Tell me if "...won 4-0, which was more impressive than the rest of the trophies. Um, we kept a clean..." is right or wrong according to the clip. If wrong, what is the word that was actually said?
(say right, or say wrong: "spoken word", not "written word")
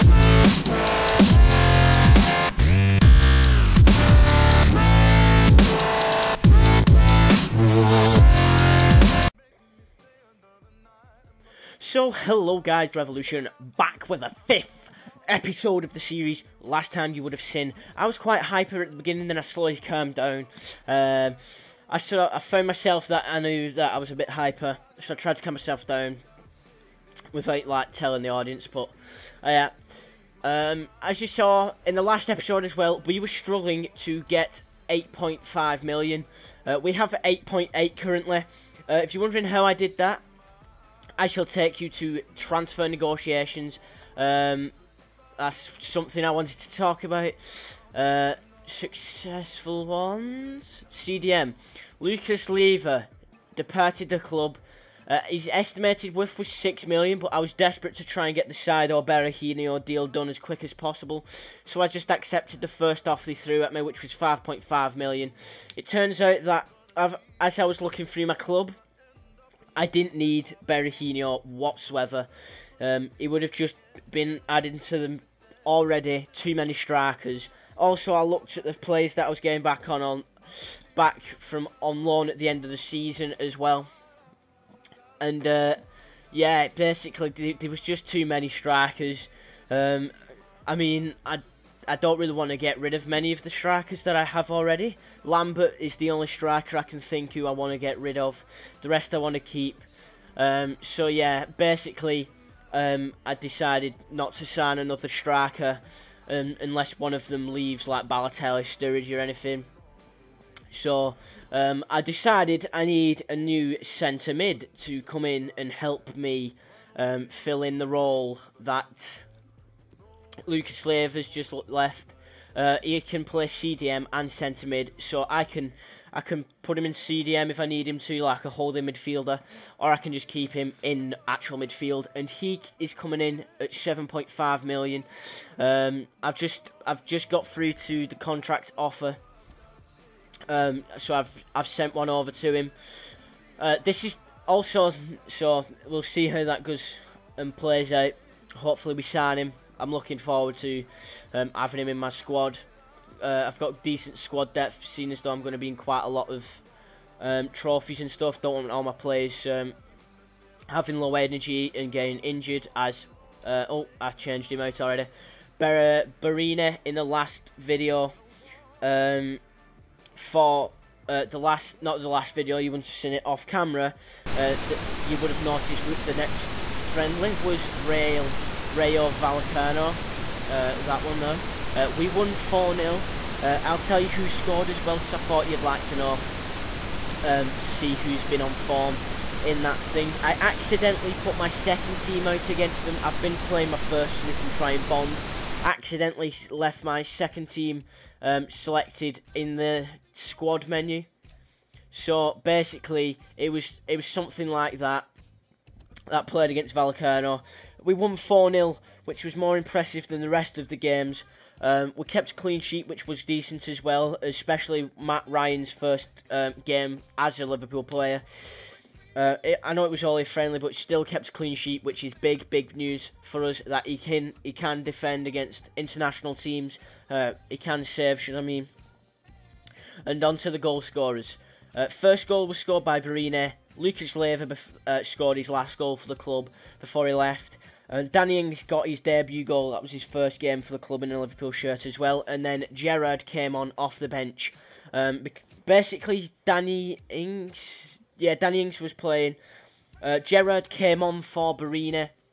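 wrong: "games", not "trophies".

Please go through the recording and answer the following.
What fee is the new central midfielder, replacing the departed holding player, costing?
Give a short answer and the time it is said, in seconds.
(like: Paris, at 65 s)
7.5 million, at 133 s.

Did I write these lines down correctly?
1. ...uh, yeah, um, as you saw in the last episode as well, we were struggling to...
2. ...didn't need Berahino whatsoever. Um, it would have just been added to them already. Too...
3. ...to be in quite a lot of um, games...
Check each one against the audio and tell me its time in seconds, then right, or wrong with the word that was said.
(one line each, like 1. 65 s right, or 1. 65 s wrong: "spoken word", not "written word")
1. 29 s right
2. 69 s right
3. 155 s wrong: "trophies", not "games".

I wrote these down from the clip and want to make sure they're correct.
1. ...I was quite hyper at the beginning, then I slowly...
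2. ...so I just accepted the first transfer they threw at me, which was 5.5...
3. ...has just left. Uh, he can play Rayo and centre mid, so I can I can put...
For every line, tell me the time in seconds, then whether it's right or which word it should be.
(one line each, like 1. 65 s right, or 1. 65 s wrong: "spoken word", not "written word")
1. 17 s right
2. 61 s wrong: "offer", not "transfer"
3. 121 s wrong: "CDM", not "Rayo".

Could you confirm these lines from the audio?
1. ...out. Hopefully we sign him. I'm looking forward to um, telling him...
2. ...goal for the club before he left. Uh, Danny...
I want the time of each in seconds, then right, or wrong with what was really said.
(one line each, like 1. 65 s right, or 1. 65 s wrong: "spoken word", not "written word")
1. 147 s wrong: "having", not "telling"
2. 235 s right.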